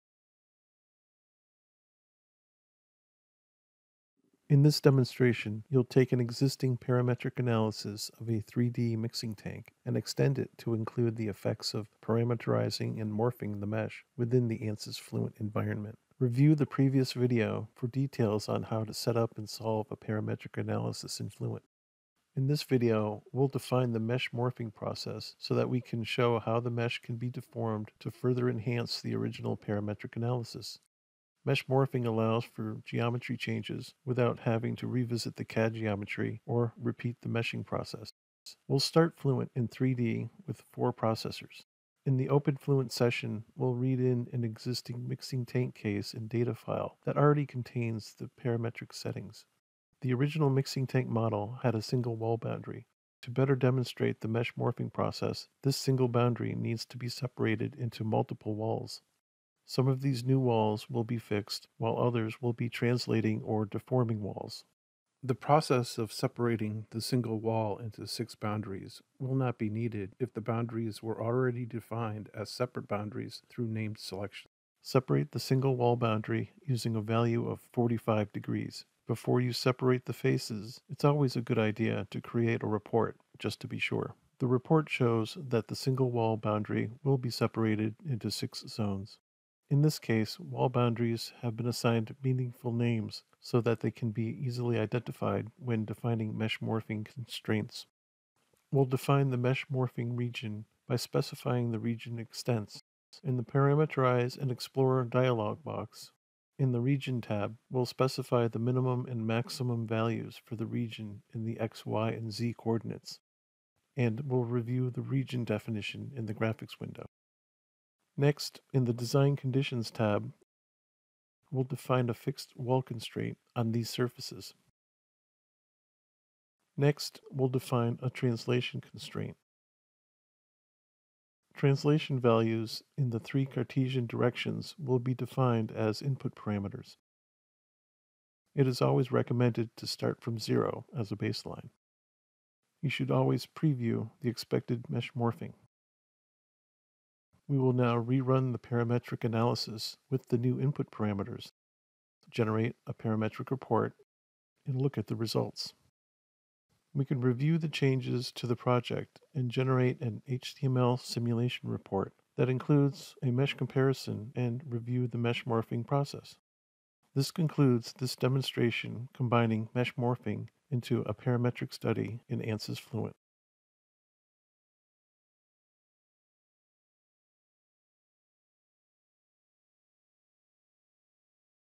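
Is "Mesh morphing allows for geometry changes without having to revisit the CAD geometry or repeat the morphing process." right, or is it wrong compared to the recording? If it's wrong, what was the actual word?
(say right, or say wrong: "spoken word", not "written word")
wrong: "meshing", not "morphing".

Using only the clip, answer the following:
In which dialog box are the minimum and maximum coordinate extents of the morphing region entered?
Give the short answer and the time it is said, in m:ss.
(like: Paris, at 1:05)
Parameterize and Explore, at 1:43.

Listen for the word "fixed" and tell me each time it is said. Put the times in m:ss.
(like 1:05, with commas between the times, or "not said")
1:01, 2:02.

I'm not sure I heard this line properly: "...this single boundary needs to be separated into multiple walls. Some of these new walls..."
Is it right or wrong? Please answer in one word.
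right.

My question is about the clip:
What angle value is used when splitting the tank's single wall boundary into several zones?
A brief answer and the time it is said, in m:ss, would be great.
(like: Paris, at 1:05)
45 degrees, at 1:17.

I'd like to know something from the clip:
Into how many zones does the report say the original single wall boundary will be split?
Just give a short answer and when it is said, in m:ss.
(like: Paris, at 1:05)
6, at 1:28.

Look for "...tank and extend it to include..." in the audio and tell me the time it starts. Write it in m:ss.
0:09.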